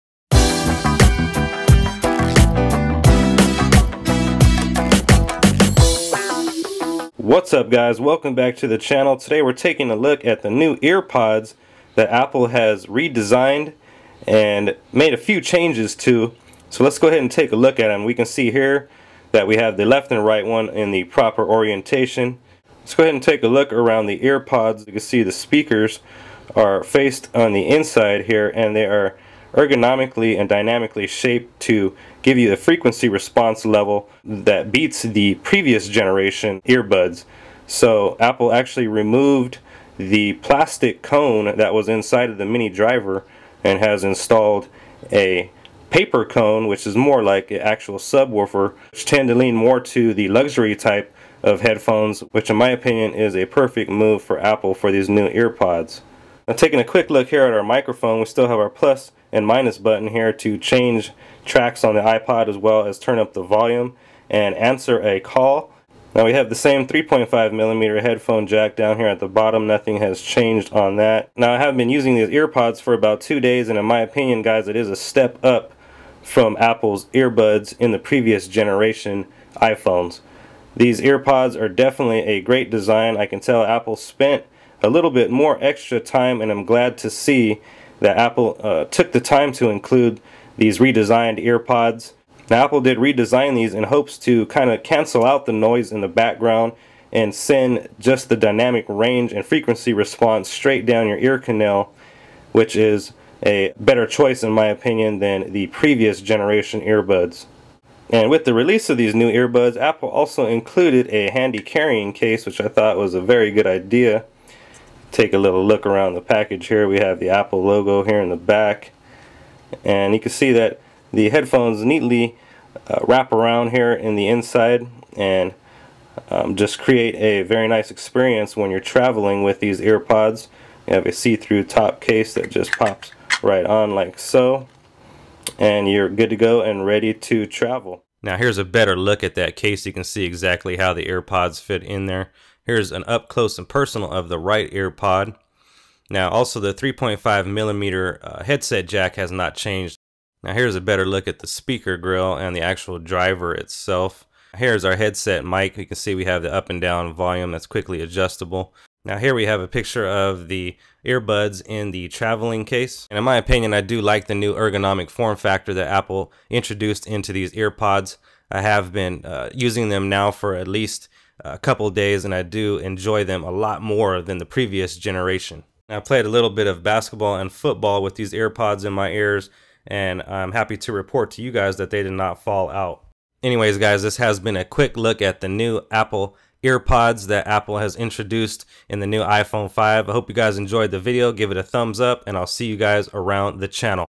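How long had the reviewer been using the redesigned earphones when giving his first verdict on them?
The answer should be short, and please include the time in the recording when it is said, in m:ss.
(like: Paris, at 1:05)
about two days, at 1:12.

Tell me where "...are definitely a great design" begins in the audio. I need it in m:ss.
1:21.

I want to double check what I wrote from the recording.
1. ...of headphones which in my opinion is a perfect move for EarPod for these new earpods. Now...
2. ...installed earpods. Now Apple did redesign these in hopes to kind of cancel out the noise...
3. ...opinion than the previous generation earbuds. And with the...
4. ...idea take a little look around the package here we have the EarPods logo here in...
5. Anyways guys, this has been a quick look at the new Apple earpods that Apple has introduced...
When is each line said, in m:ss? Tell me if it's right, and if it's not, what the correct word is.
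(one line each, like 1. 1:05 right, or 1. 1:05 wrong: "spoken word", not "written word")
1. 0:51 wrong: "Apple", not "EarPod"
2. 1:30 wrong: "redesigned", not "installed"
3. 1:44 right
4. 1:53 wrong: "Apple", not "EarPods"
5. 3:03 right.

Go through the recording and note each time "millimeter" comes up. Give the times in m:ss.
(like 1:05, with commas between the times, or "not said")
1:07, 2:27.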